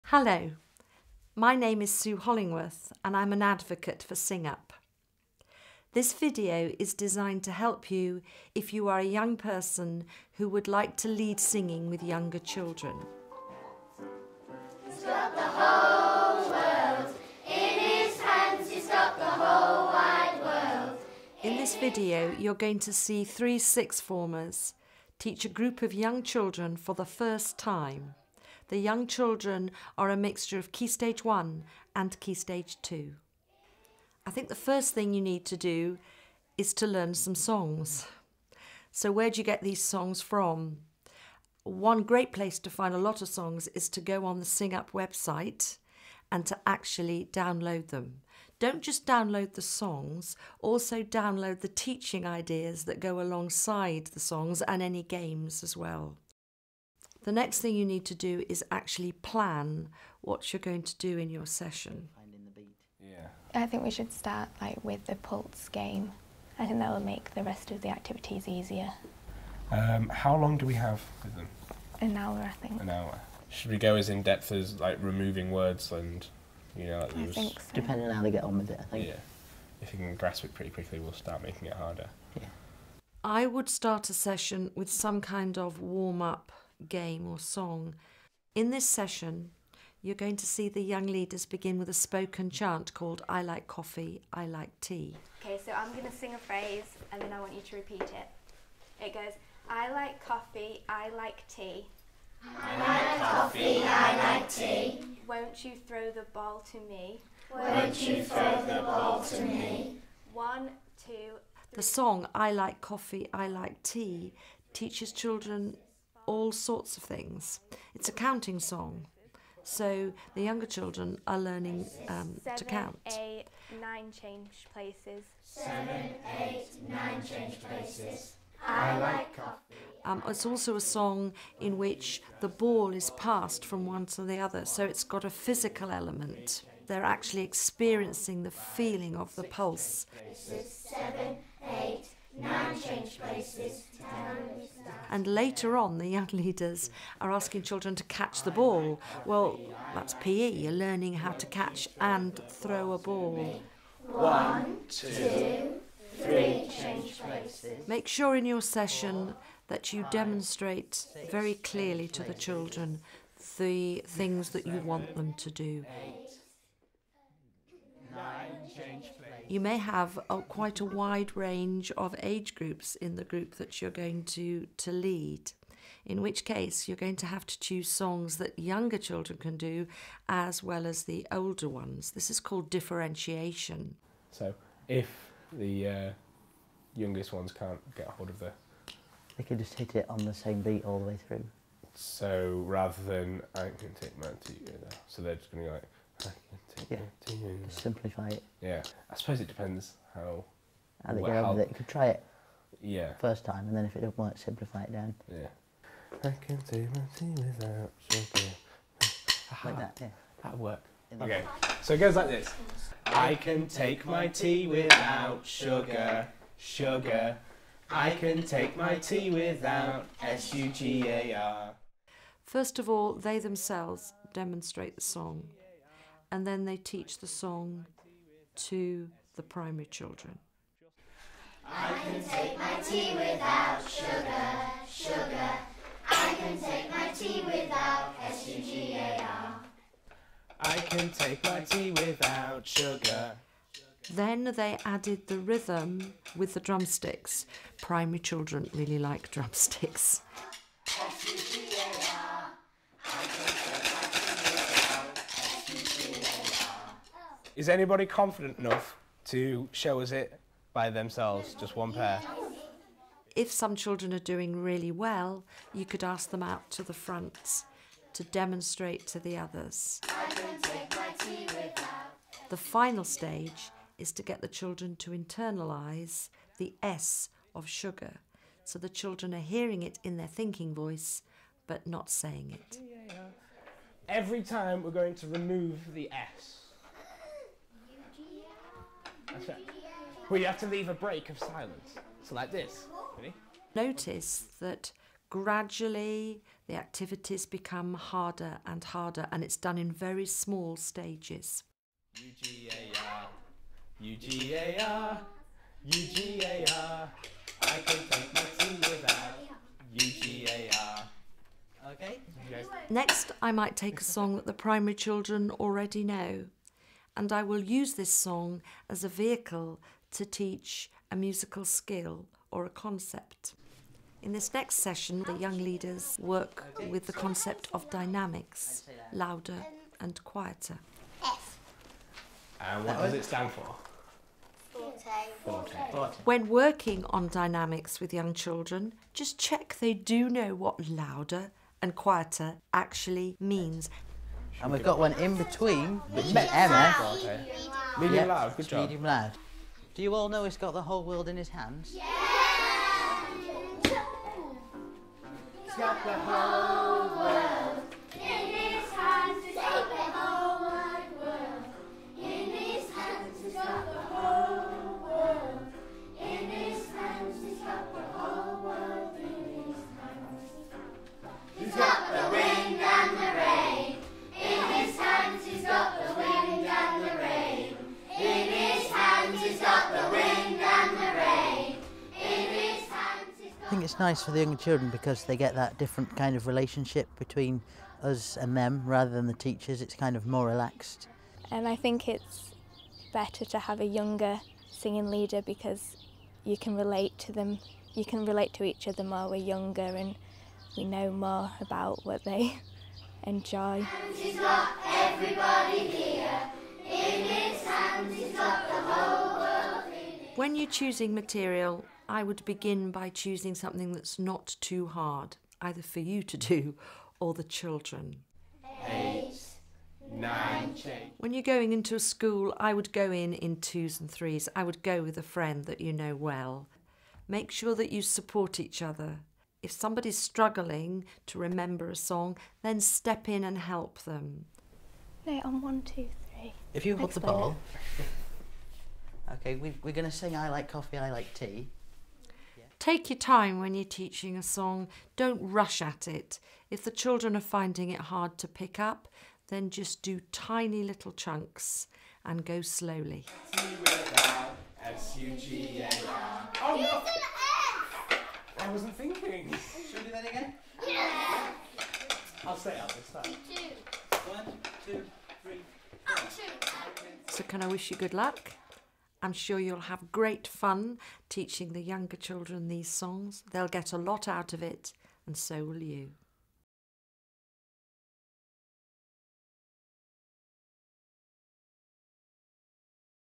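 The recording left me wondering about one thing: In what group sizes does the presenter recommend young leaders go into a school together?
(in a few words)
Twos and threes.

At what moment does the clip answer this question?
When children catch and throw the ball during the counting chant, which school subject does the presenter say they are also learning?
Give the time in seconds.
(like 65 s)
150 s.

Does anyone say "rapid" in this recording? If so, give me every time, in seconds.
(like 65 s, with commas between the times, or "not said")
not said.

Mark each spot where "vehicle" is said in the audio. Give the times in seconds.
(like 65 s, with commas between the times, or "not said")
319 s.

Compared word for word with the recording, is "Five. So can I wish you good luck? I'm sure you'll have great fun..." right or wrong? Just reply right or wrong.
wrong.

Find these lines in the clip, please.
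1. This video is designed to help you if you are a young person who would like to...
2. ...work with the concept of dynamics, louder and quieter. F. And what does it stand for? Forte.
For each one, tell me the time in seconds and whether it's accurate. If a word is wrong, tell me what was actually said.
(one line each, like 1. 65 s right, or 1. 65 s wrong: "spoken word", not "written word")
1. 5 s right
2. 326 s right.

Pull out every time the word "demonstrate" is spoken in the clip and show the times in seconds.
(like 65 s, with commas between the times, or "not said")
160 s, 224 s, 268 s.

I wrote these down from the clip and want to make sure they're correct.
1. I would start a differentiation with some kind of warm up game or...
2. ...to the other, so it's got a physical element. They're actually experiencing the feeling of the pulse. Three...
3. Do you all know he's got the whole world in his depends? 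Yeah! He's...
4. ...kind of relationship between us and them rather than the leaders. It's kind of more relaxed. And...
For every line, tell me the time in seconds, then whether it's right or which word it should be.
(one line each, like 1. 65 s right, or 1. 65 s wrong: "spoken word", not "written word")
1. 83 s wrong: "session", not "differentiation"
2. 134 s wrong: "Seven", not "Three"
3. 349 s wrong: "hands", not "depends"
4. 386 s wrong: "teachers", not "leaders".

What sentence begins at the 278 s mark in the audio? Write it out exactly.
So the children are hearing it in their thinking voice, but not saying it.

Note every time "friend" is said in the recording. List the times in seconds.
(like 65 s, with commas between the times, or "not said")
425 s.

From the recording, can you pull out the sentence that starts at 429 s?
If somebody's struggling to remember a song, then step in and help them.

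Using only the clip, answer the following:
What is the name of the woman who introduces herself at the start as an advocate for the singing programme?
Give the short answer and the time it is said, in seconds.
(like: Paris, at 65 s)
Sue Hollingworth, at 1 s.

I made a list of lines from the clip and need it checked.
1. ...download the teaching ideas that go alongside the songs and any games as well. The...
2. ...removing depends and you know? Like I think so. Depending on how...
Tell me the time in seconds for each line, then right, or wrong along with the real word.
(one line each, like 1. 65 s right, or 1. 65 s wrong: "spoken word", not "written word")
1. 51 s right
2. 75 s wrong: "words", not "depends".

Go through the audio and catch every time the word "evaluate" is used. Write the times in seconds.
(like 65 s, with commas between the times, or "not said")
not said.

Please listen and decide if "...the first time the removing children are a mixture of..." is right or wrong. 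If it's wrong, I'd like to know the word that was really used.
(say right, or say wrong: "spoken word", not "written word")
wrong: "young", not "removing".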